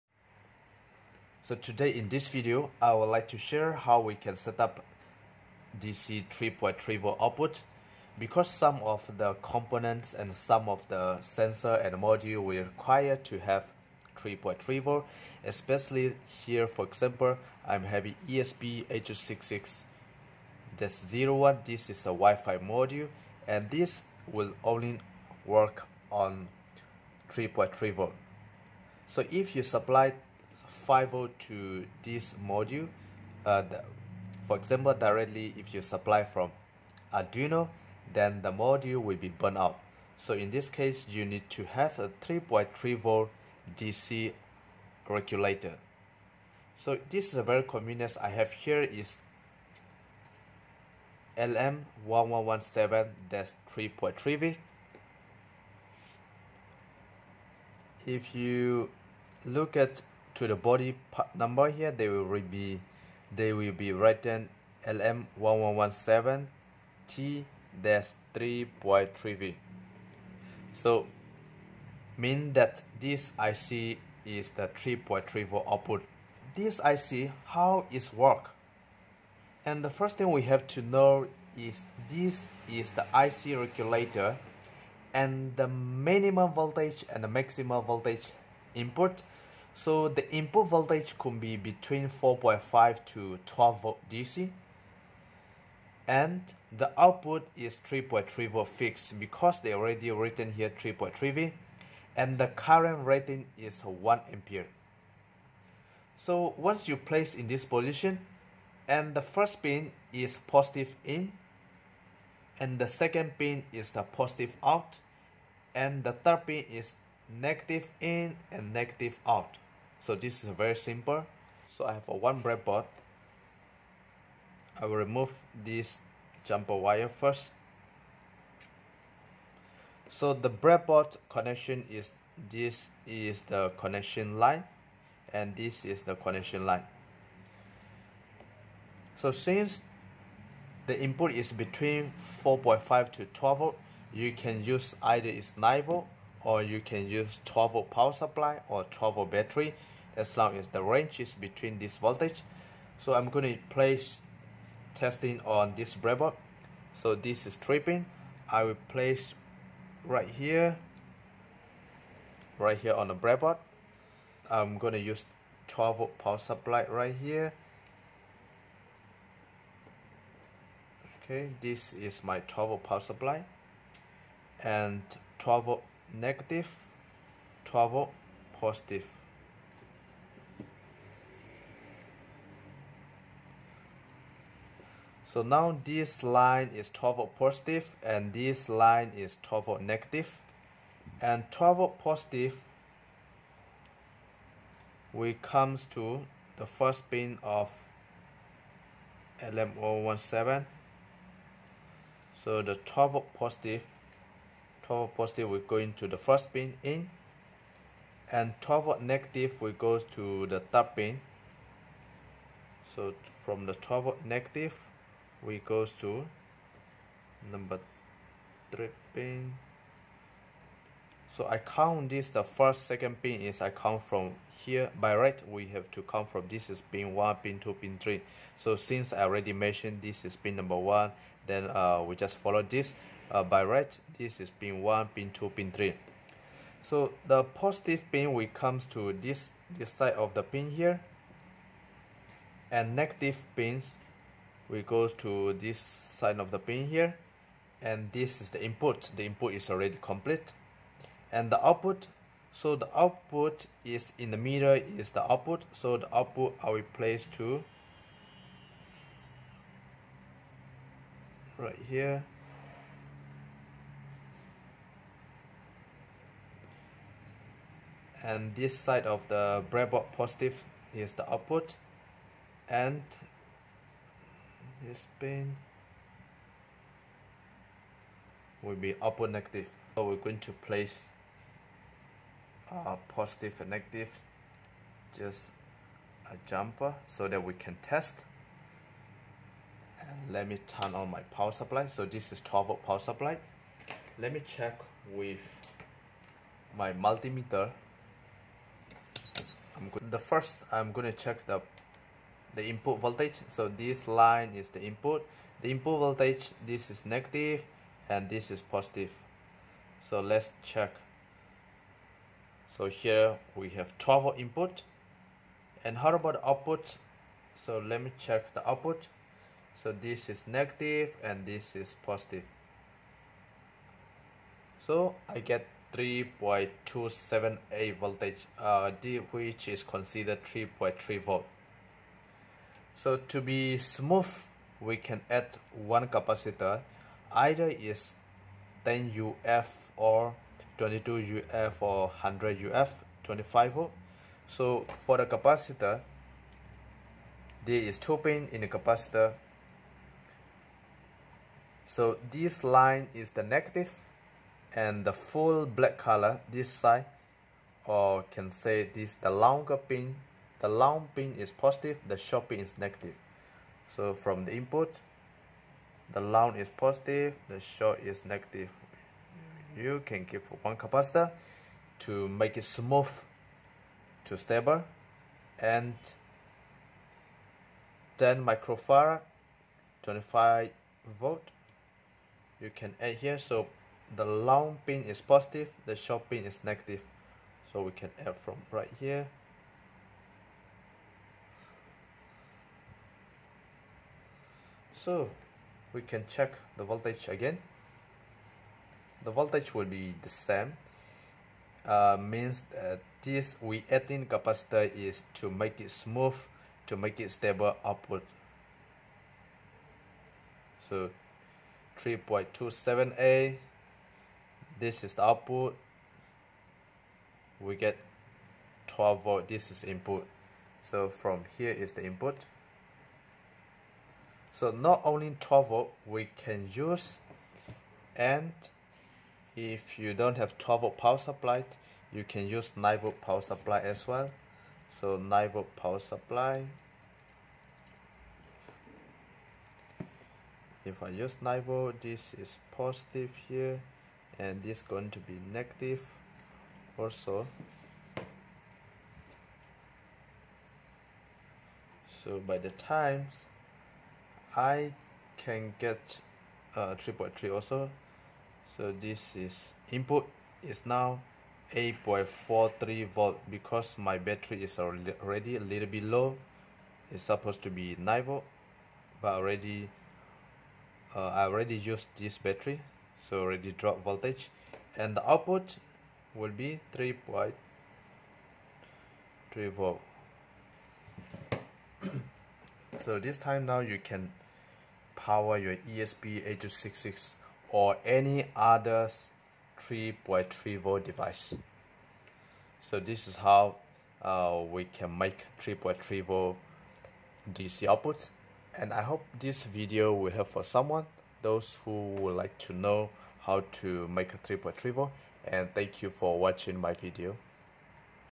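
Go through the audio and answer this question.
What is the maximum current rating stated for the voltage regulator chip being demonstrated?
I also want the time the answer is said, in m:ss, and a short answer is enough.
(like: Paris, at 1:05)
1 ampere, at 1:43.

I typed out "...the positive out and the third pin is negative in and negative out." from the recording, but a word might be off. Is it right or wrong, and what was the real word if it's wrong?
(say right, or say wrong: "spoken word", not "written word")
right.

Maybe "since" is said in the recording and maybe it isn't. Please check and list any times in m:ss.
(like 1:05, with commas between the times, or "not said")
2:19, 3:48.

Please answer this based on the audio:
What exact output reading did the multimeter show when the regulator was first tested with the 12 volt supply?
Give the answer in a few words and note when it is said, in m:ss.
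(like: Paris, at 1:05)
3.278 volts, at 5:25.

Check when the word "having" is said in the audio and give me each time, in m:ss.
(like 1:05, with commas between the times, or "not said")
0:17.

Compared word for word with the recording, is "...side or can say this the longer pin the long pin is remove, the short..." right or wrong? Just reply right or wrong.
wrong.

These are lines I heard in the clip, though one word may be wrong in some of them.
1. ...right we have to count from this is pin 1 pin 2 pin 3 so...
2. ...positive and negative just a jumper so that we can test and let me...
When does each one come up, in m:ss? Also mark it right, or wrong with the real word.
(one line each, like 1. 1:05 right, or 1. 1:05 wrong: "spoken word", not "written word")
1. 3:45 right
2. 4:43 right.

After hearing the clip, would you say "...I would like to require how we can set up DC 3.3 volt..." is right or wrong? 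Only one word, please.
wrong.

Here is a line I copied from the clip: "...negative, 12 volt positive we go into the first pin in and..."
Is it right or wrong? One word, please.
wrong.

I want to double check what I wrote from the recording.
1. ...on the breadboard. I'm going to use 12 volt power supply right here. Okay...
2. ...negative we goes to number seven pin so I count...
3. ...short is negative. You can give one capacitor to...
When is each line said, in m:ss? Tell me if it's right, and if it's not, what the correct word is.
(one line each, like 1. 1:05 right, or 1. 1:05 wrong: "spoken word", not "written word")
1. 2:42 right
2. 3:34 wrong: "three", not "seven"
3. 6:07 right.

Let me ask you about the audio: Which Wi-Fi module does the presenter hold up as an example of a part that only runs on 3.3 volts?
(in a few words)
ESP8266-01.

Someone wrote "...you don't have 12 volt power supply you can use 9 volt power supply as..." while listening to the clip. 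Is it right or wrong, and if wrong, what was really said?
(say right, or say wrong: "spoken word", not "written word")
right.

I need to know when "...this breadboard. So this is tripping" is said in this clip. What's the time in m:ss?
2:35.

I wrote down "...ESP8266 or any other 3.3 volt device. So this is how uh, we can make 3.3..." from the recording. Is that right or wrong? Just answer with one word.
right.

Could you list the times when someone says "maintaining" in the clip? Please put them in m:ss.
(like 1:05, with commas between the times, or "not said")
not said.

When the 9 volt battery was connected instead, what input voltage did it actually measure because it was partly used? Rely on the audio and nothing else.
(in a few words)
8.43 volts.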